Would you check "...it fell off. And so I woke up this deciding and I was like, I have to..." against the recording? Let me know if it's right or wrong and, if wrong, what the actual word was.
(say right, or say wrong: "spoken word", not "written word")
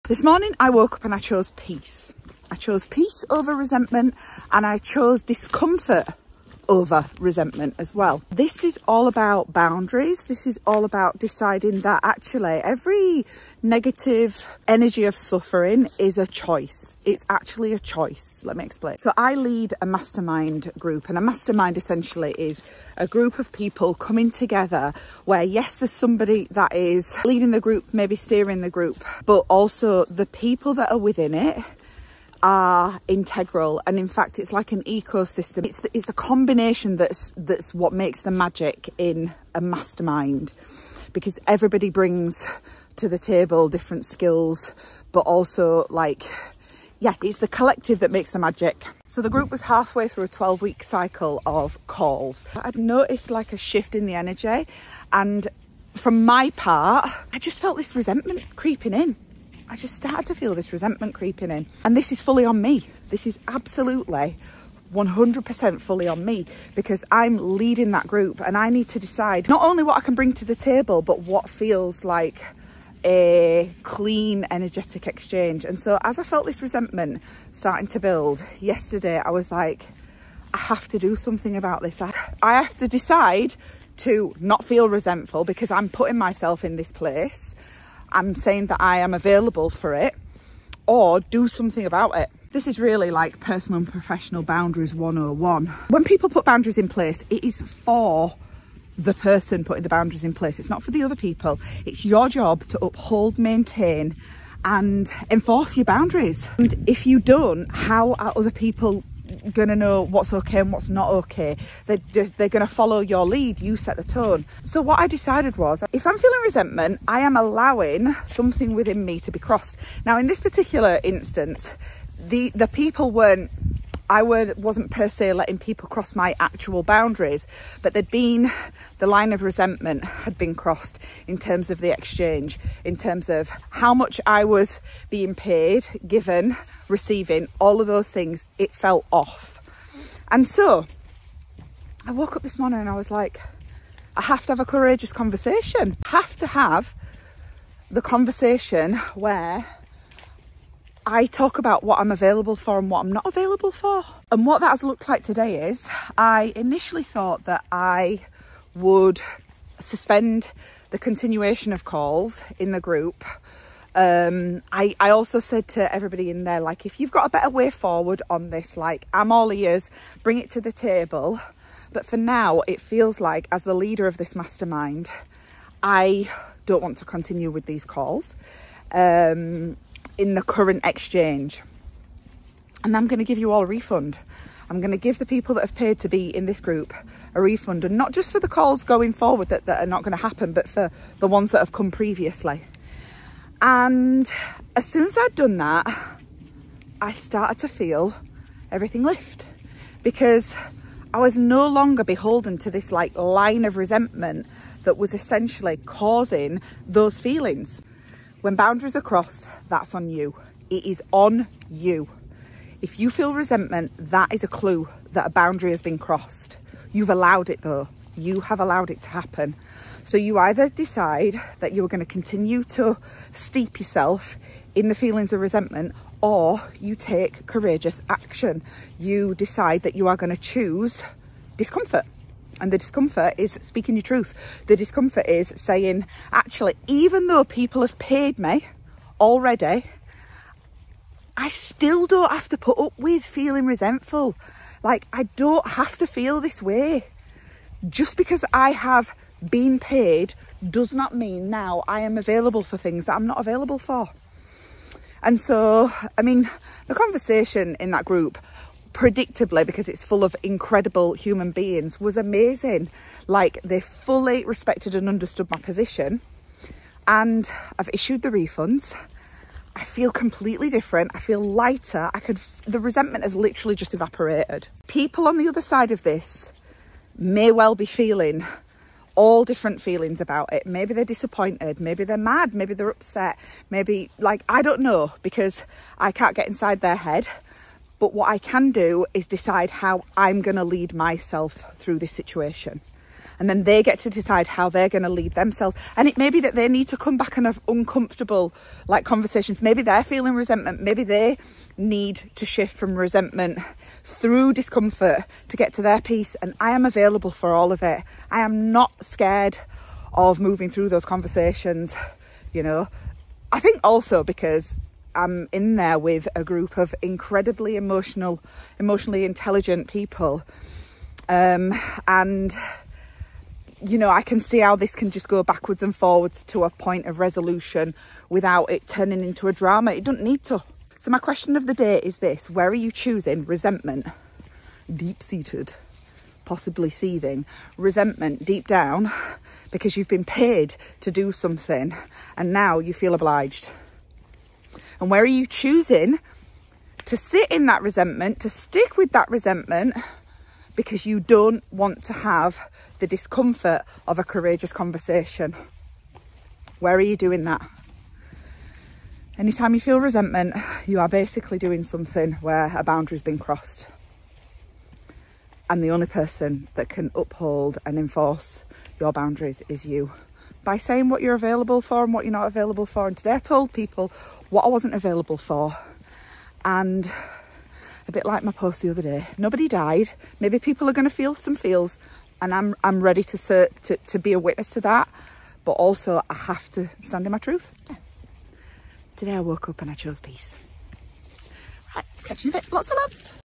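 wrong: "morning", not "deciding".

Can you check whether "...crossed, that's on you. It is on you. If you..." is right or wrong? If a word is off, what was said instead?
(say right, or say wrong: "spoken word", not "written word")
right.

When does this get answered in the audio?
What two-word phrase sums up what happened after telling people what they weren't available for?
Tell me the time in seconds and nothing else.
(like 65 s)
379 s.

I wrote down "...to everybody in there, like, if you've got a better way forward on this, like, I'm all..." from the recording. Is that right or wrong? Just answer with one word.
right.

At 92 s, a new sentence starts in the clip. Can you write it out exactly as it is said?
This is really like personal and professional boundaries 101.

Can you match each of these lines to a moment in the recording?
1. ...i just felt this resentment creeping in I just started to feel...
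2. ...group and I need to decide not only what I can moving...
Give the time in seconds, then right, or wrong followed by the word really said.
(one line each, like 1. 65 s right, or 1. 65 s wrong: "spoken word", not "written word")
1. 57 s right
2. 68 s wrong: "bring", not "moving".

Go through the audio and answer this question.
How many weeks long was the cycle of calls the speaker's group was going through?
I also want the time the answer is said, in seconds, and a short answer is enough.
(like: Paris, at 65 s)
12, at 50 s.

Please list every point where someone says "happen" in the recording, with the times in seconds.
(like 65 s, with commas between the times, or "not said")
190 s, 219 s.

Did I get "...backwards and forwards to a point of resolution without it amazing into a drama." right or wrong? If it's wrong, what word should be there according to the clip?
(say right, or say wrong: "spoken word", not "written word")
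wrong: "turning", not "amazing".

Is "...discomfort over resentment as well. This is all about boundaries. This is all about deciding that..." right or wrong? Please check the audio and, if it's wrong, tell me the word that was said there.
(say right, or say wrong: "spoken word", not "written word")
right.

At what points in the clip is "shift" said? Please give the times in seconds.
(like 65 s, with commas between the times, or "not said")
53 s, 302 s.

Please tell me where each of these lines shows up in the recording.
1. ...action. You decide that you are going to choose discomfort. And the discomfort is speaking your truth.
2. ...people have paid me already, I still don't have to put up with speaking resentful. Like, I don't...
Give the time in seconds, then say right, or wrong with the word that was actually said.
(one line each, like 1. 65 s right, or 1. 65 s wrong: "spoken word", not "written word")
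1. 228 s right
2. 237 s wrong: "feeling", not "speaking".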